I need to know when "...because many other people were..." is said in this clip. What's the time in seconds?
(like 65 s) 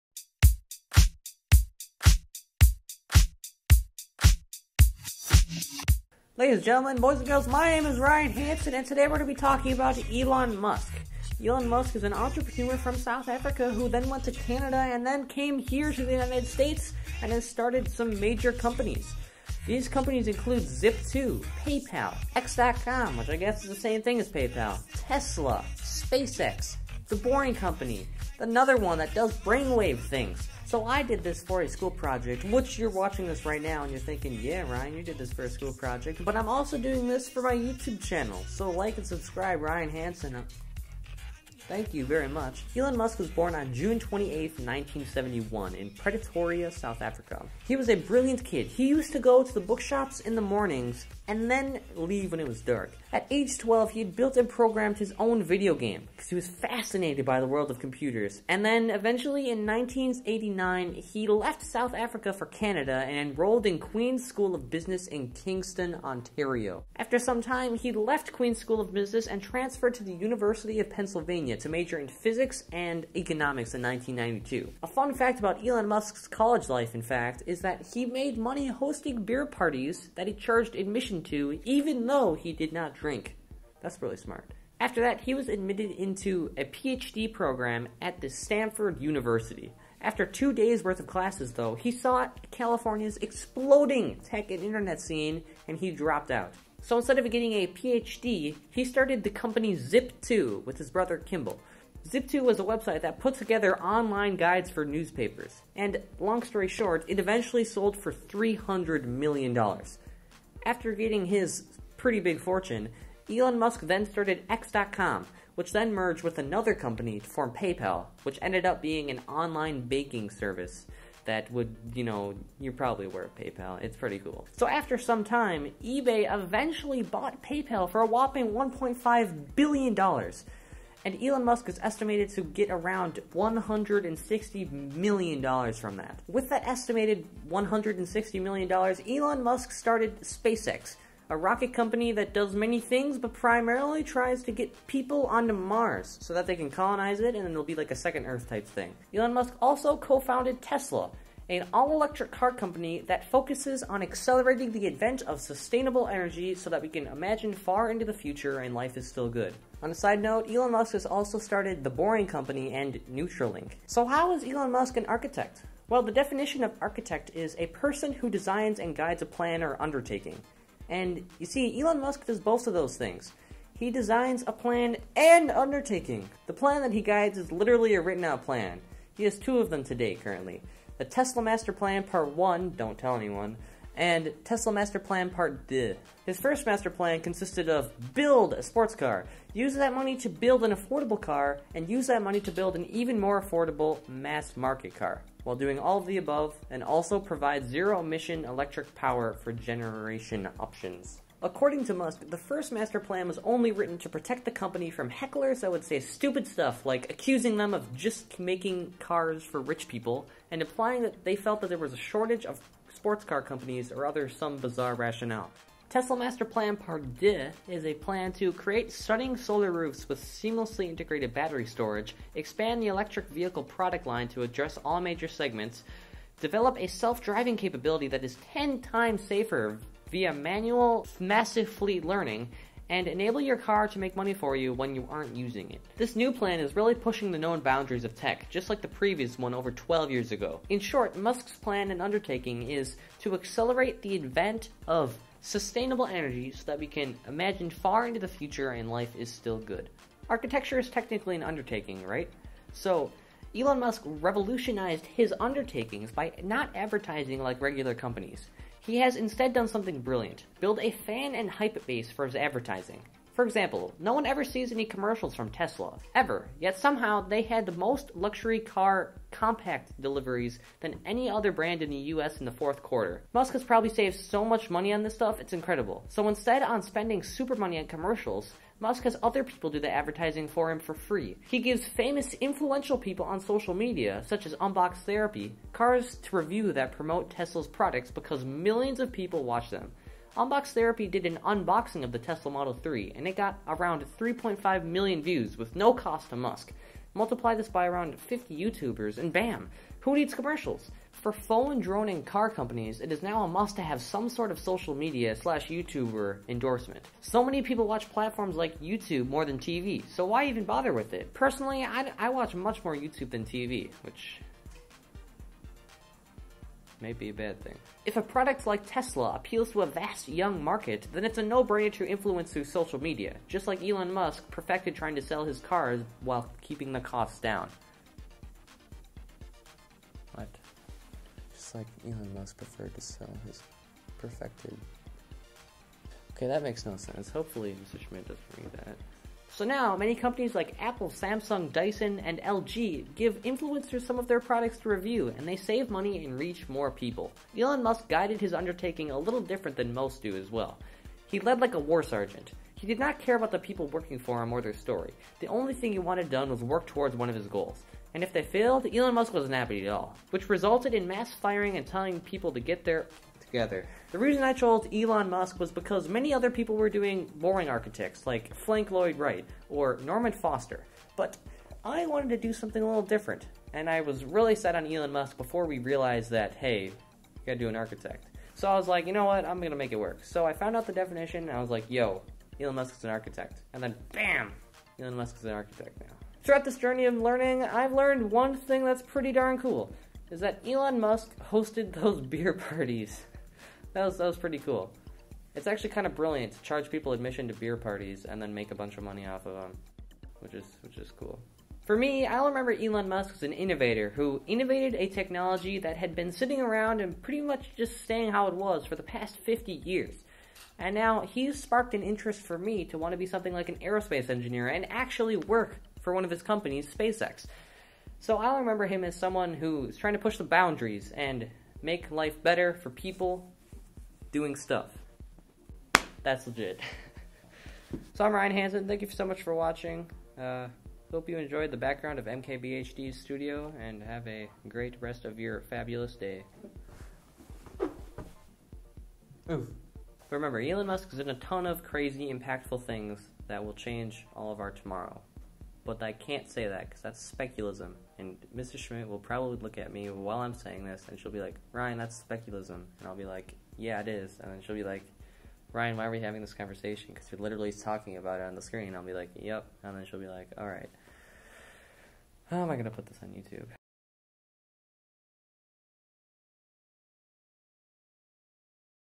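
365 s.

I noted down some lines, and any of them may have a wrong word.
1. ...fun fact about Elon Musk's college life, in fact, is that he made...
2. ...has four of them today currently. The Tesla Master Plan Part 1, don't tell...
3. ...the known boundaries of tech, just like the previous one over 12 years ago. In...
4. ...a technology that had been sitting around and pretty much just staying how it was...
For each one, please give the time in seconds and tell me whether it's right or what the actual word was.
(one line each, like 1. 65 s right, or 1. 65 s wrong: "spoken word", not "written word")
1. 74 s right
2. 179 s wrong: "two", not "four"
3. 237 s right
4. 404 s right.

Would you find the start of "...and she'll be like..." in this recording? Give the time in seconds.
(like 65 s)
451 s.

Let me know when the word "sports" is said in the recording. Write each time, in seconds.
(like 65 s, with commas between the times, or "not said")
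188 s, 212 s.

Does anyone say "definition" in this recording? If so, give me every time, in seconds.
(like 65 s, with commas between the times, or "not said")
166 s, 380 s.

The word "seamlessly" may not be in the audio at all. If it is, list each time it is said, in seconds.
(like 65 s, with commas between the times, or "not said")
220 s.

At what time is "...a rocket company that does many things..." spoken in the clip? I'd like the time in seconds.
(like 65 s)
141 s.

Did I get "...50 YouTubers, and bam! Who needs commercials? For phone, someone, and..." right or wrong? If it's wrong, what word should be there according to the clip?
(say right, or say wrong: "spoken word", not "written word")
wrong: "drone", not "someone".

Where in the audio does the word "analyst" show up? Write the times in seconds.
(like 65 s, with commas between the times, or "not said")
not said.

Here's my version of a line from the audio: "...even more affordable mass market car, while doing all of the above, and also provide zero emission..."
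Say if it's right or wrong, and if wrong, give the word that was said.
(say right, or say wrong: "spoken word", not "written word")
right.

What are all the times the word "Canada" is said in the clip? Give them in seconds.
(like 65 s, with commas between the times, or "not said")
14 s, 62 s.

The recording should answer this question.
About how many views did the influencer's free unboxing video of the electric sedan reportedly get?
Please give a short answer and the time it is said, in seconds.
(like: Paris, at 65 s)
3.5 million, at 294 s.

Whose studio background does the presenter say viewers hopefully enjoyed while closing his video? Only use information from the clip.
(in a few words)
MKBHD.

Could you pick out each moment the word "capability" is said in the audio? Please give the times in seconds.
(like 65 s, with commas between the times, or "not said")
227 s.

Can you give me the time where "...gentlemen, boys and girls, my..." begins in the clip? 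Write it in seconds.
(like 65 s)
6 s.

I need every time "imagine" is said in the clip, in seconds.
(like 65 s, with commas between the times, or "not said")
157 s, 247 s.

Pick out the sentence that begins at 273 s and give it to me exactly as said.
Musk has probably saved so much money on this stuff, it's incredible.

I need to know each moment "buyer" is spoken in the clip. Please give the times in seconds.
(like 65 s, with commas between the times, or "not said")
not said.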